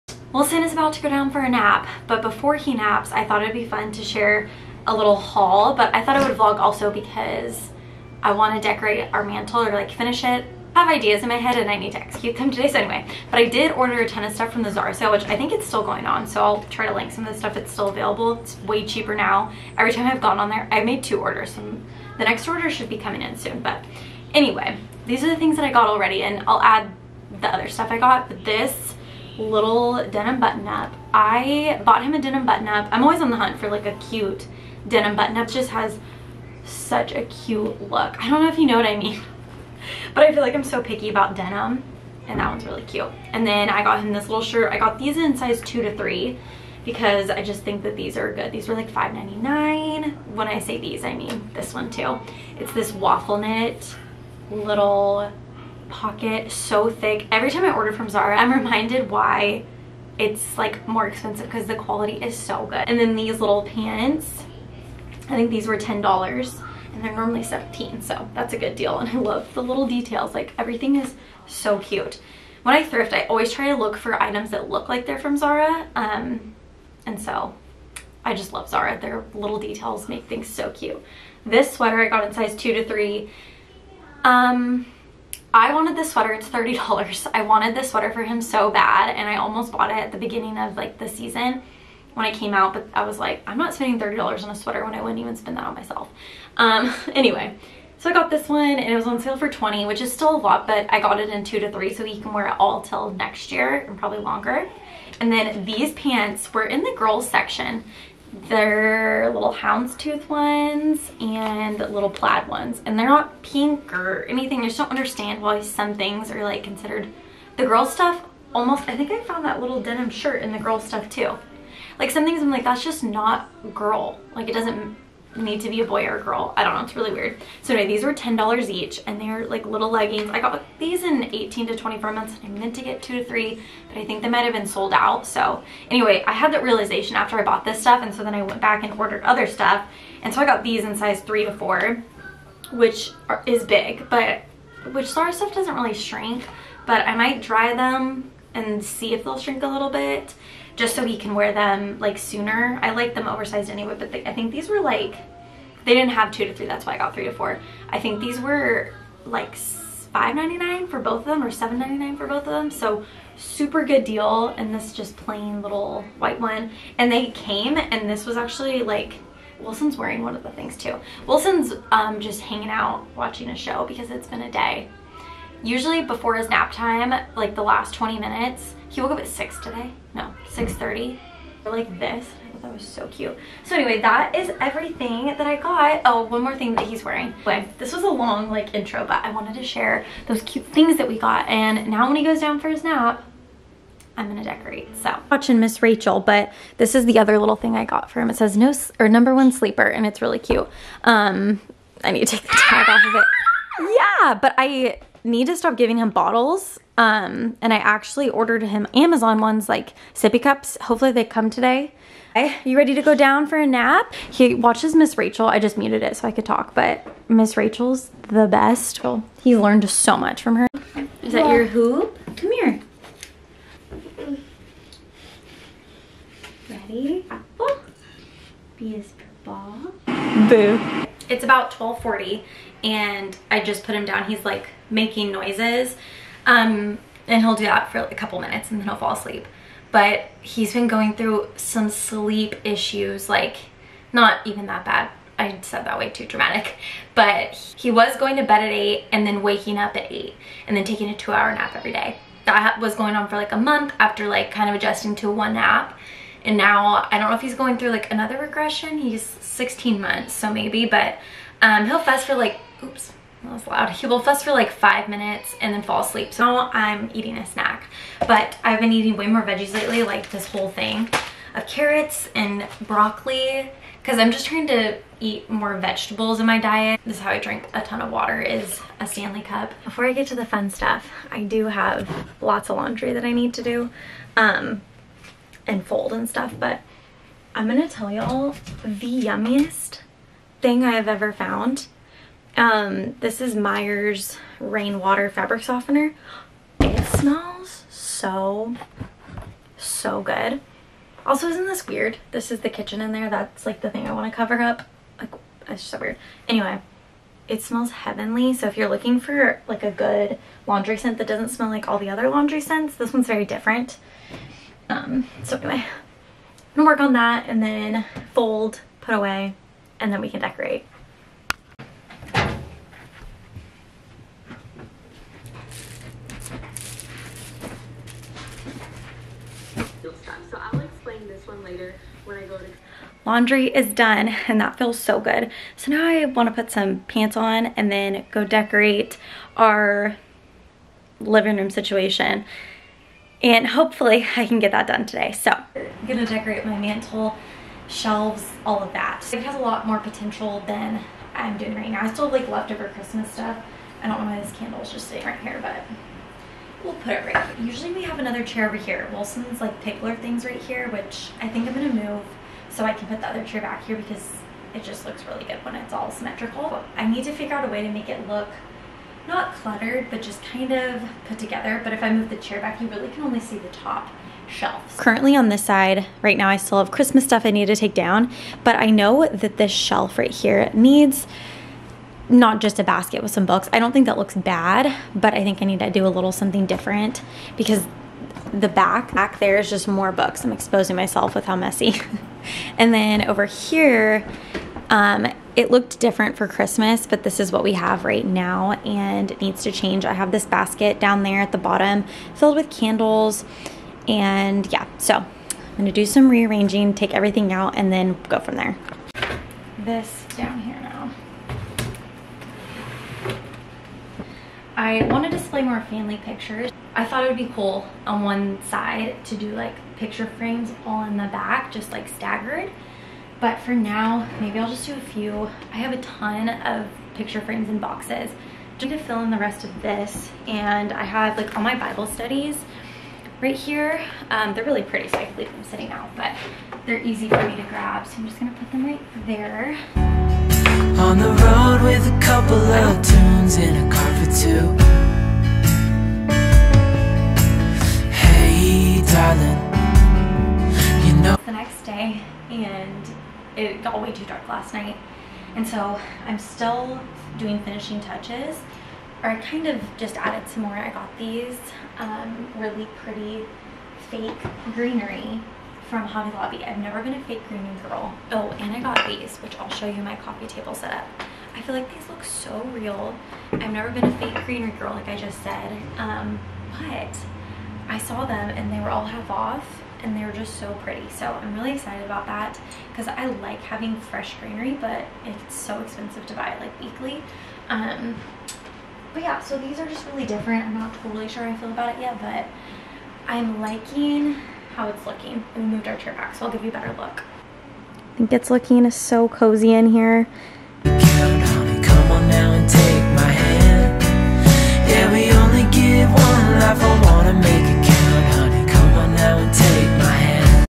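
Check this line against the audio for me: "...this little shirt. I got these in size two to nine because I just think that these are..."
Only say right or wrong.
wrong.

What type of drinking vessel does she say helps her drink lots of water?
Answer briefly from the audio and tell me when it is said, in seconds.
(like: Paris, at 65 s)
Stanley cup, at 279 s.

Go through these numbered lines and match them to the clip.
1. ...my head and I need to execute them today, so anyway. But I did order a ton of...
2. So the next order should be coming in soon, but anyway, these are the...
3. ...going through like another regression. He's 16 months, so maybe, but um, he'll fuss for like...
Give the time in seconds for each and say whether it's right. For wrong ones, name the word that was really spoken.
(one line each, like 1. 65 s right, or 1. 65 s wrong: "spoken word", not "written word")
1. 11 s right
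2. 21 s right
3. 257 s right.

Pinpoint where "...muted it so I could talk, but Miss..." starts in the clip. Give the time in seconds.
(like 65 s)
215 s.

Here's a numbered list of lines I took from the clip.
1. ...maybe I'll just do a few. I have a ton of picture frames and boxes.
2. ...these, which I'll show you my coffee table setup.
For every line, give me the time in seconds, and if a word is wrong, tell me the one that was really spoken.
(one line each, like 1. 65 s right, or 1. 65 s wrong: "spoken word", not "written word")
1. 424 s right
2. 469 s right.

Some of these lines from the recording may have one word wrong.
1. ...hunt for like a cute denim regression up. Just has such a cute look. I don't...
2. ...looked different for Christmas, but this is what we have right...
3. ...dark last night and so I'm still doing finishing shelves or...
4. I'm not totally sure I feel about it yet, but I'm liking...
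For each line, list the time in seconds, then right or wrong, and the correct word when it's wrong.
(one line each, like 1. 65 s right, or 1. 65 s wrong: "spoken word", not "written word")
1. 33 s wrong: "button", not "regression"
2. 395 s right
3. 454 s wrong: "touches", not "shelves"
4. 490 s right.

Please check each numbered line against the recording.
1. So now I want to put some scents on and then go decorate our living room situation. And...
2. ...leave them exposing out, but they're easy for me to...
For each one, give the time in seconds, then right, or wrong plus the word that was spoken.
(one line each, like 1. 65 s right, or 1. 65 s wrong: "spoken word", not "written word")
1. 335 s wrong: "pants", not "scents"
2. 435 s wrong: "sitting", not "exposing".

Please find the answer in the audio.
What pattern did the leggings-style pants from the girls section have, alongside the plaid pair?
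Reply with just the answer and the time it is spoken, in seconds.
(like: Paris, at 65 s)
Houndstooth, at 109 s.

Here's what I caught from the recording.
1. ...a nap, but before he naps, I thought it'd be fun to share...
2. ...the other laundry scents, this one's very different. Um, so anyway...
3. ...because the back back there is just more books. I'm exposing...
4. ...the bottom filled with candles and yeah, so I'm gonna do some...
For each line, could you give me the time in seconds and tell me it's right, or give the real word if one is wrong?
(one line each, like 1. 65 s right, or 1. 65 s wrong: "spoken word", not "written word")
1. 1 s right
2. 311 s right
3. 387 s right
4. 401 s right.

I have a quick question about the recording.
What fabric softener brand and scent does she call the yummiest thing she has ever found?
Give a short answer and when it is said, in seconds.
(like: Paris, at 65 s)
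Myers Rainwater, at 293 s.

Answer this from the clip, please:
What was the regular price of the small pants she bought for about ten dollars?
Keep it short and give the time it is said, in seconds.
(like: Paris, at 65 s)
17, at 67 s.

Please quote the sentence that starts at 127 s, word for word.
So anyway, these were $10 each and they're like little leggings.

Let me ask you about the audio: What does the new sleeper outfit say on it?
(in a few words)
Number one sleeper.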